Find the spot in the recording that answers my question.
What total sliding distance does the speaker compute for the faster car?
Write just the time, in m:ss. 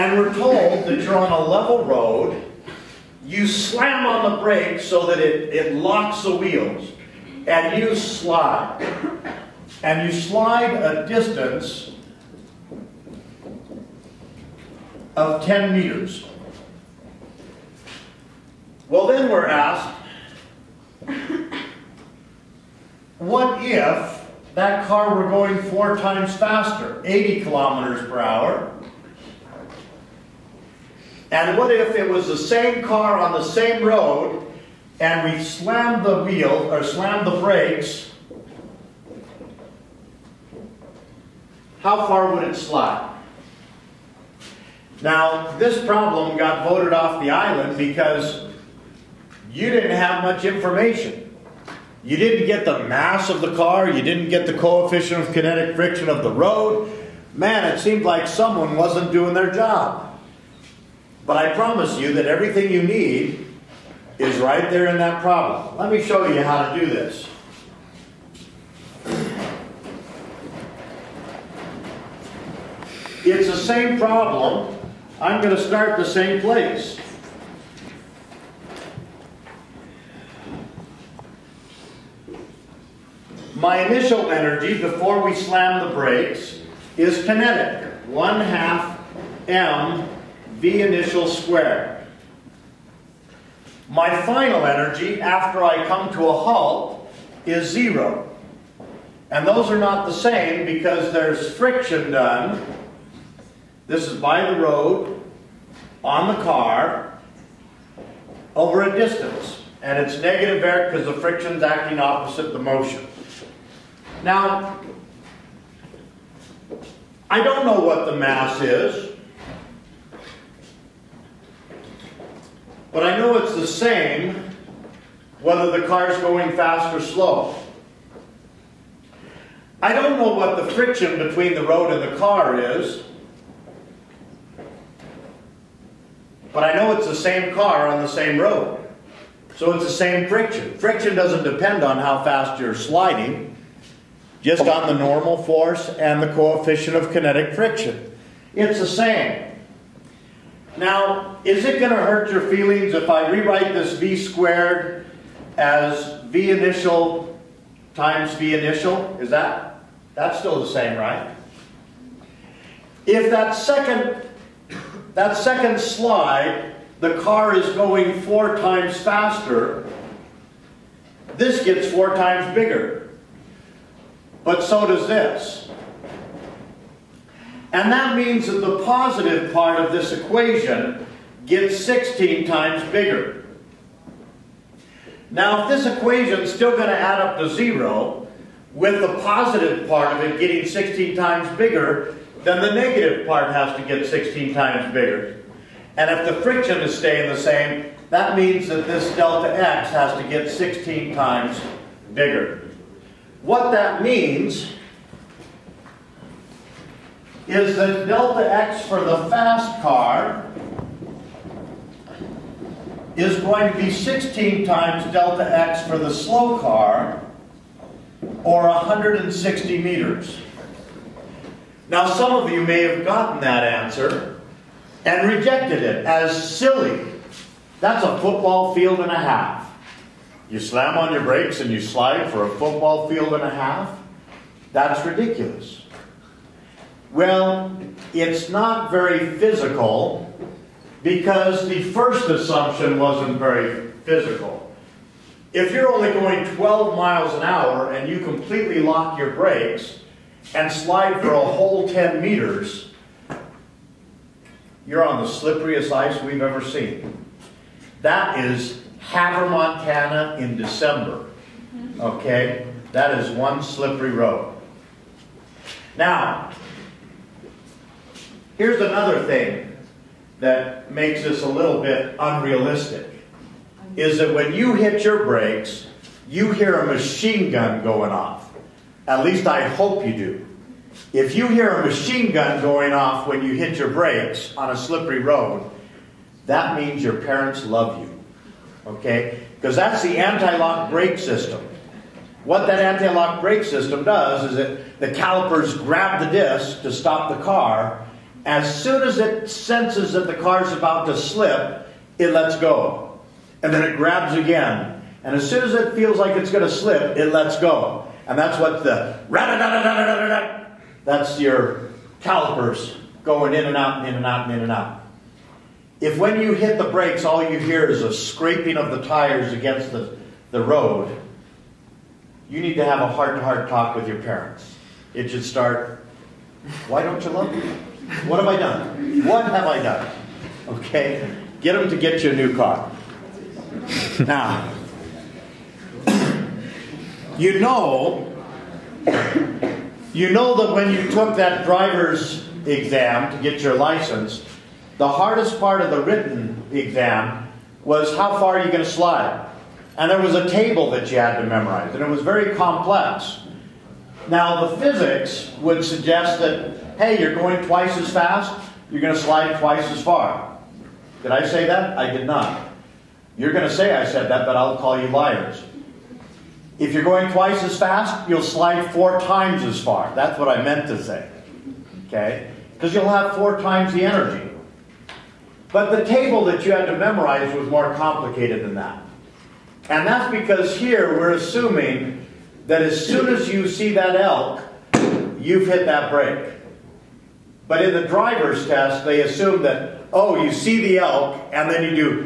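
3:38.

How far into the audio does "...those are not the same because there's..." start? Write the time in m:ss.
1:39.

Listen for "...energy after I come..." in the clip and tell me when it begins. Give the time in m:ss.
1:34.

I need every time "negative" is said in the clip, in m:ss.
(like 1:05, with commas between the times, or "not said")
1:50, 3:12.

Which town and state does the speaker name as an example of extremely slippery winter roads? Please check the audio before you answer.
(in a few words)
Havre, Montana.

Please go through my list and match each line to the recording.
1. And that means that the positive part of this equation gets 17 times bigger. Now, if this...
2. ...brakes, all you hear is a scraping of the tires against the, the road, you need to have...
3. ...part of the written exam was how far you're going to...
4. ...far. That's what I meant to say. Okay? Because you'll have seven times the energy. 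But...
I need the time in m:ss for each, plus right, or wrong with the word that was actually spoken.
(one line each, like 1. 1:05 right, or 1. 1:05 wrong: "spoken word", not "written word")
1. 2:57 wrong: "16", not "17"
2. 5:16 right
3. 5:45 right
4. 6:09 wrong: "four", not "seven".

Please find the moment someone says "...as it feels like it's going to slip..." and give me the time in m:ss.
5:05.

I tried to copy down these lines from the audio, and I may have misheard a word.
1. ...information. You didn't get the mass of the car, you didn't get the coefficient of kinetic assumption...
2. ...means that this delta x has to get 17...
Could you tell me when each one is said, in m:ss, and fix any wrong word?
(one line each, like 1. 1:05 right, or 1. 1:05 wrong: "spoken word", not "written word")
1. 0:50 wrong: "friction", not "assumption"
2. 3:18 wrong: "16", not "17".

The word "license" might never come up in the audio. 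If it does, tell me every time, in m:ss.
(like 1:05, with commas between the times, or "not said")
5:43.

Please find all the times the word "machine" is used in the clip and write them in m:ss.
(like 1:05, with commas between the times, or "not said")
4:36, 4:41.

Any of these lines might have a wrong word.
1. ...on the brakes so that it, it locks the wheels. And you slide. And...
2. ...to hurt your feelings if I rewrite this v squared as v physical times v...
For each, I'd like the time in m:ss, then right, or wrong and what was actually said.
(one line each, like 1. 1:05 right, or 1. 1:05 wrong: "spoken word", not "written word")
1. 0:04 right
2. 2:31 wrong: "initial", not "physical".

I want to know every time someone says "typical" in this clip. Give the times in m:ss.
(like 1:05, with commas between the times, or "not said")
not said.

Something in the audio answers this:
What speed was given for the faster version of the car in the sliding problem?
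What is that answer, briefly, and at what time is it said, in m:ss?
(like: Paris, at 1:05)
80 kilometers per hour, at 0:27.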